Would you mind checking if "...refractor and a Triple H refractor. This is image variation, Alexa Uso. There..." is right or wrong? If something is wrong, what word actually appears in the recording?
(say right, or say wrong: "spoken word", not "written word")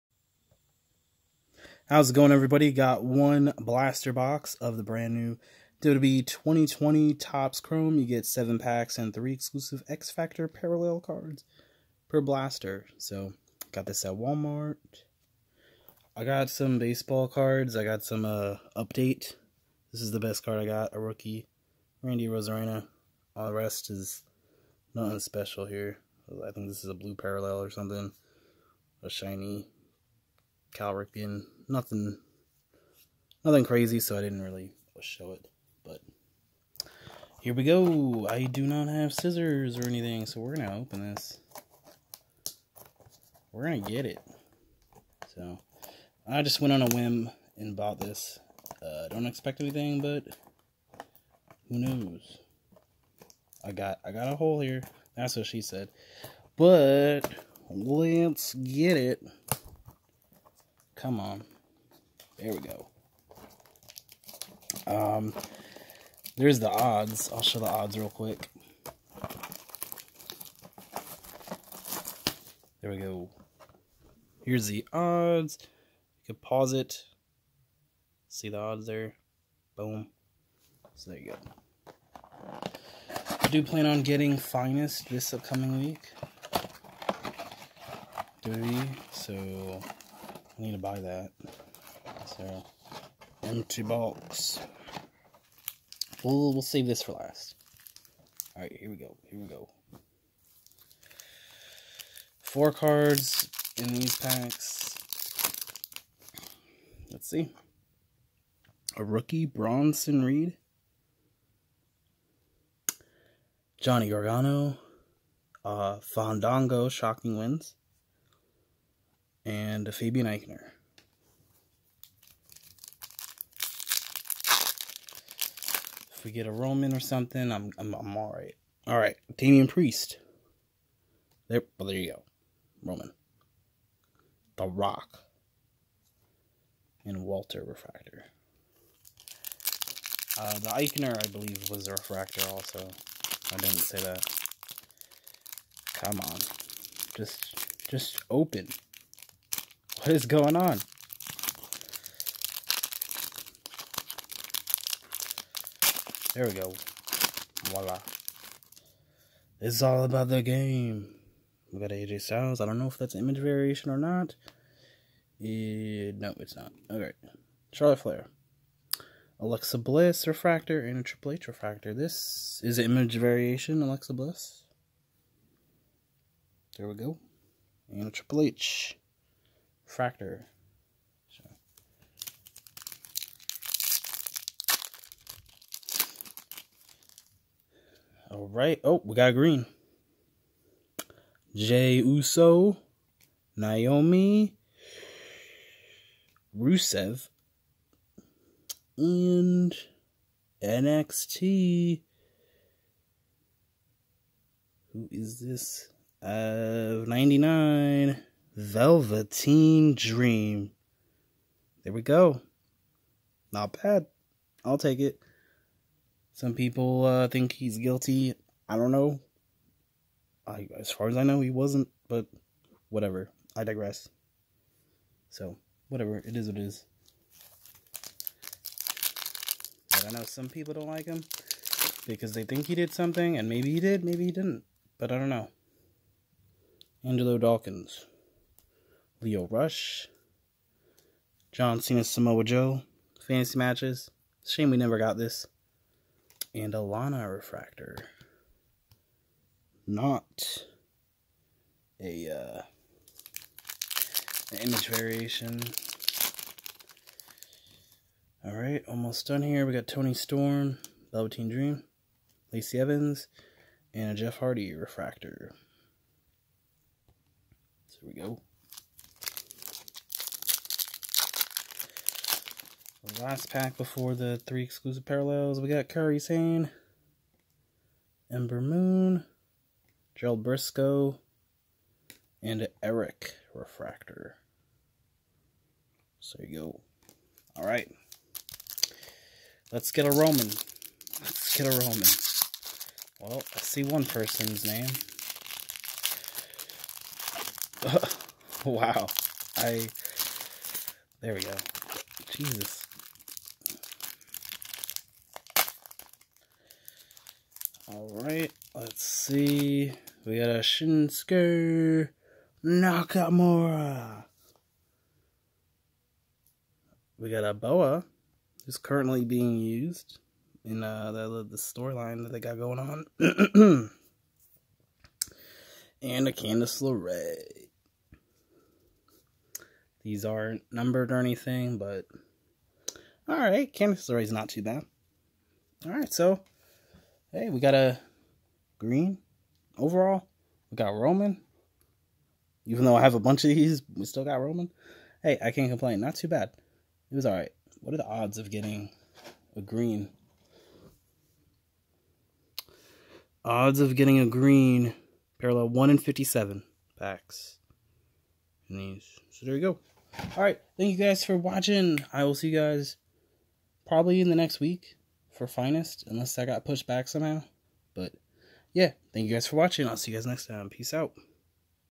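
wrong: "Bliss", not "Uso".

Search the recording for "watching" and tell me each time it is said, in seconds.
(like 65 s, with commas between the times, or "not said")
361 s, 369 s.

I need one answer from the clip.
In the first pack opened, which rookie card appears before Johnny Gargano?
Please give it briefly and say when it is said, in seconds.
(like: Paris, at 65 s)
Bronson Reed, at 109 s.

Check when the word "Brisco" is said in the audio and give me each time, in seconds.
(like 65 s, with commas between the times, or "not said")
280 s.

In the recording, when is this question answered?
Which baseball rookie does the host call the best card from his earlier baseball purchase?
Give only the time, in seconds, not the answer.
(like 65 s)
22 s.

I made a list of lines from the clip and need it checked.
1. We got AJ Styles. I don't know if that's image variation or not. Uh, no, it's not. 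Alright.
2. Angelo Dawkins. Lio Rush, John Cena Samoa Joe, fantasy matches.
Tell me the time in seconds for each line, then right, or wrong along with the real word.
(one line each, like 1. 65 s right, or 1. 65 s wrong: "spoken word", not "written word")
1. 161 s right
2. 237 s right.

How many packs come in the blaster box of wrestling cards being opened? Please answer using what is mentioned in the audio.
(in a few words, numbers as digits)
7.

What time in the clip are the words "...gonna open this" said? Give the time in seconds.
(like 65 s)
40 s.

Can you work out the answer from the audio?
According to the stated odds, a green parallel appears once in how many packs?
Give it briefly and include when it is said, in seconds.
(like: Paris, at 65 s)
57, at 355 s.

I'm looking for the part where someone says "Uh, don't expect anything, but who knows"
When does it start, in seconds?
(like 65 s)
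48 s.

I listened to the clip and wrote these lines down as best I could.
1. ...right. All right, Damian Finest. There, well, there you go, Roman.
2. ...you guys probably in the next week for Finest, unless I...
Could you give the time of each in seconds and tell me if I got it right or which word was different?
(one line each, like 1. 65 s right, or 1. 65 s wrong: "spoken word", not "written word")
1. 128 s wrong: "Priest", not "Finest"
2. 362 s right.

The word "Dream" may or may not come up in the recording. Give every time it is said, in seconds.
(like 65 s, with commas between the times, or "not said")
209 s, 261 s.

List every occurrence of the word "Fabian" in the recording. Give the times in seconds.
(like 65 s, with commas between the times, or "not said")
119 s.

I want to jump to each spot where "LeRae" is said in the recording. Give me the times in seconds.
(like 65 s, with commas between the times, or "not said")
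326 s, 334 s.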